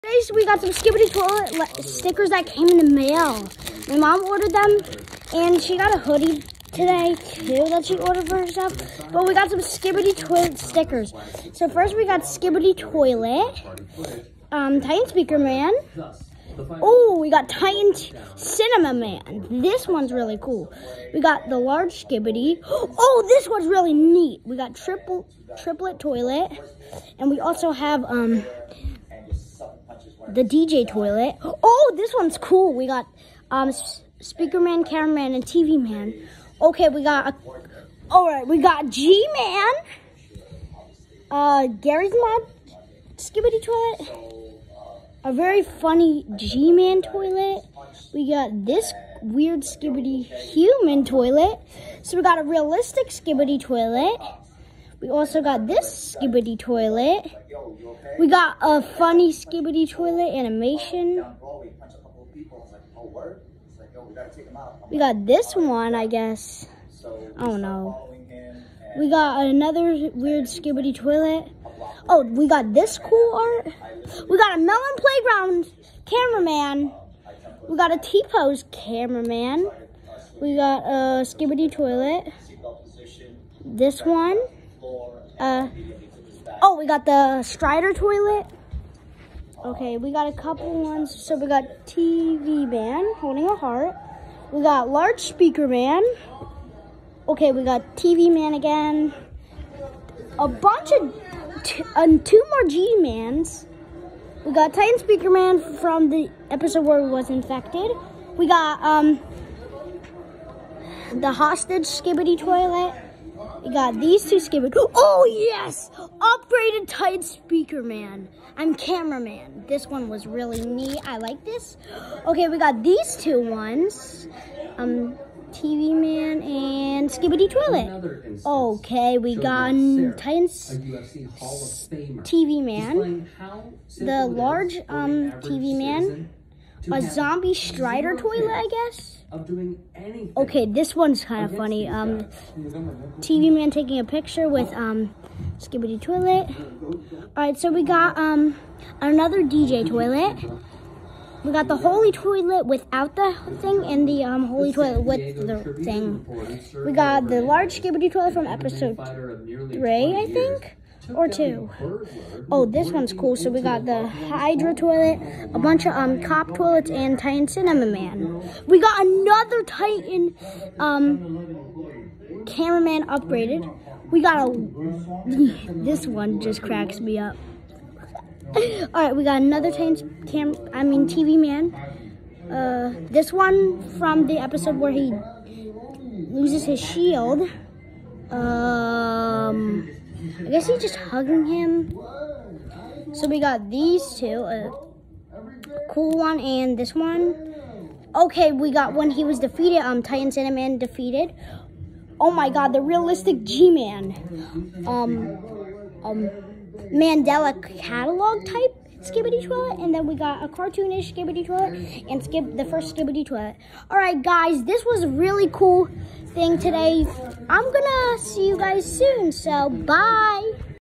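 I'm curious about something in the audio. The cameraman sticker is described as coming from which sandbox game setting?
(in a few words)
Melon Playground.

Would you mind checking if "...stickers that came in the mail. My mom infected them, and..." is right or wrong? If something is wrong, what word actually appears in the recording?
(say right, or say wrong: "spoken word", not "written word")
wrong: "ordered", not "infected".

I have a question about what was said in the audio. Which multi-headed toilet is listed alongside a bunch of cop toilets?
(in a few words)
Hydra toilet.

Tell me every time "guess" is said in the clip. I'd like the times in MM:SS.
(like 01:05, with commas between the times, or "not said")
01:06, 02:18, 03:10.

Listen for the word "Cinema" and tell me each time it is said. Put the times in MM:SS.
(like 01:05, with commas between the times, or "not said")
00:18, 02:47.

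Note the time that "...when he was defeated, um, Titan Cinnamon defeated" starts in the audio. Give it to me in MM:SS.
03:18.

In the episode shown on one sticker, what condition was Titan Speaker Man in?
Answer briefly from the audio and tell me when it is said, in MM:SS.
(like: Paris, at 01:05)
Infected, at 01:47.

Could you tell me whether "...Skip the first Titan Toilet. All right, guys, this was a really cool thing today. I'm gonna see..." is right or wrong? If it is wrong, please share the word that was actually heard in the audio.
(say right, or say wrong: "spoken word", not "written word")
wrong: "Skibidi", not "Titan".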